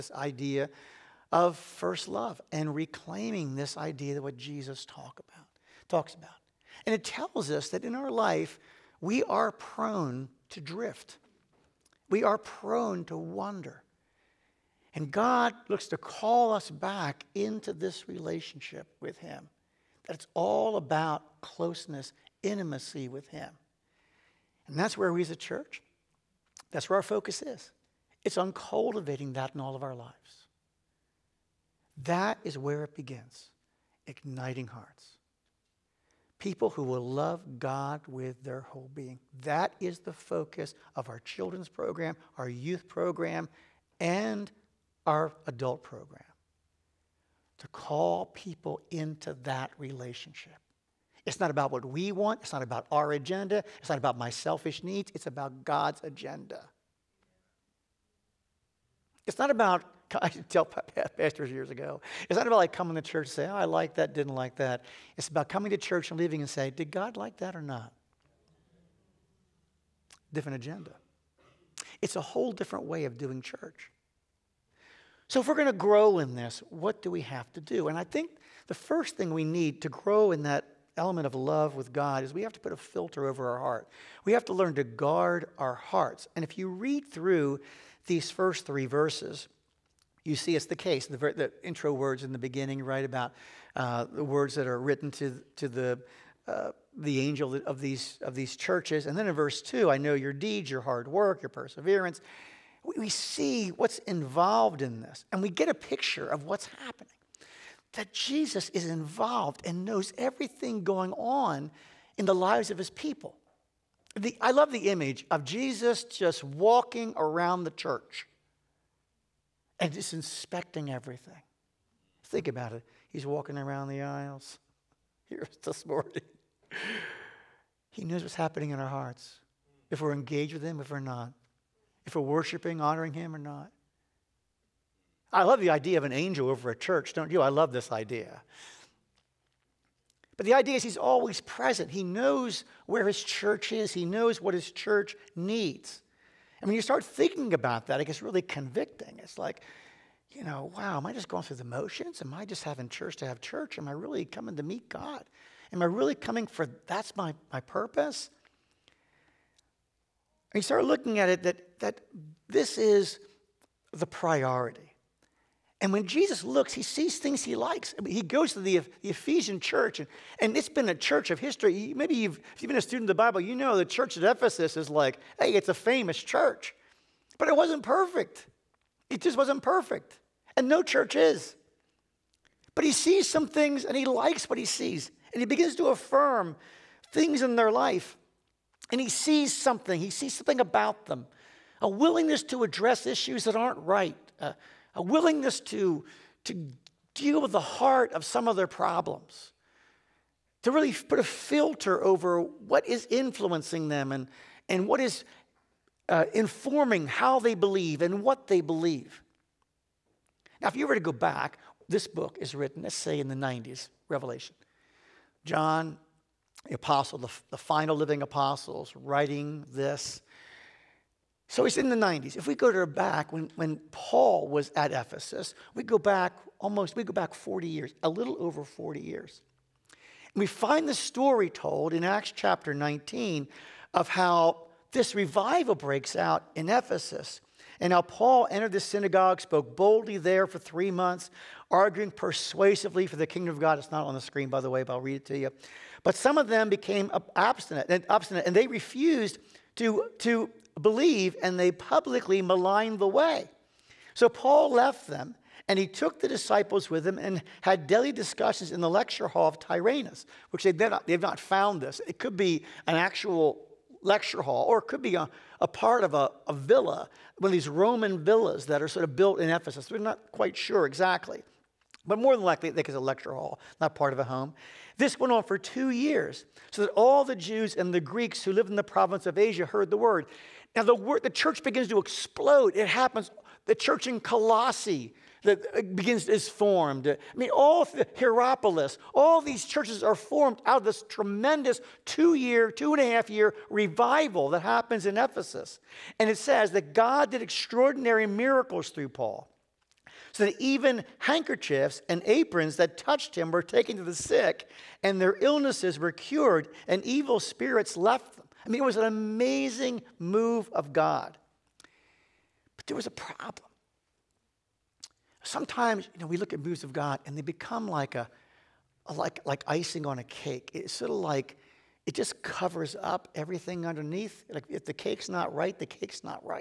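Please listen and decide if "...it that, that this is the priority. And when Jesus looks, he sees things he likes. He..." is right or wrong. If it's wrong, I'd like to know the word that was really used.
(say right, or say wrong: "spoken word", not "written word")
right.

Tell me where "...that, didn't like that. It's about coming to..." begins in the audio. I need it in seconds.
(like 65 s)
63 s.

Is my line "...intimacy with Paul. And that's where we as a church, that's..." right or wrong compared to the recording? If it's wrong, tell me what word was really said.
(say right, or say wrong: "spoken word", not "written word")
wrong: "Him", not "Paul".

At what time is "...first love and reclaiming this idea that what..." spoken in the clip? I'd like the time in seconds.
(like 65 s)
1 s.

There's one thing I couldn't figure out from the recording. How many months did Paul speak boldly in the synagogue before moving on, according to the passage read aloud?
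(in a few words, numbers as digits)
3.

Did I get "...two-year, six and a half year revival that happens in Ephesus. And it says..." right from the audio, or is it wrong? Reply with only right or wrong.
wrong.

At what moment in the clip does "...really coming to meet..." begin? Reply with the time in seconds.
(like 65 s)
153 s.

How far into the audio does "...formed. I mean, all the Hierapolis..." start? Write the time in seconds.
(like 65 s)
286 s.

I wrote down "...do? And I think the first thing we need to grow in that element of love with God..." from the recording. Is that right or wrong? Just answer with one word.
right.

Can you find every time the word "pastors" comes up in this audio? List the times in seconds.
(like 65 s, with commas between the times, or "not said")
60 s.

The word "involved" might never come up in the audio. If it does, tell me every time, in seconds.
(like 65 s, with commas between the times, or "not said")
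103 s, 108 s.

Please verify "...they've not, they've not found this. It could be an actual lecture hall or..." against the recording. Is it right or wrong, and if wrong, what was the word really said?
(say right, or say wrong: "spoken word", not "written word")
right.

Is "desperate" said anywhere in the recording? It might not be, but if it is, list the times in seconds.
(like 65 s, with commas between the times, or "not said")
not said.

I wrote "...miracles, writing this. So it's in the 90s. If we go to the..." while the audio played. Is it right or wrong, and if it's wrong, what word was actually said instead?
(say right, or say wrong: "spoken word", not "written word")
wrong: "apostles", not "miracles".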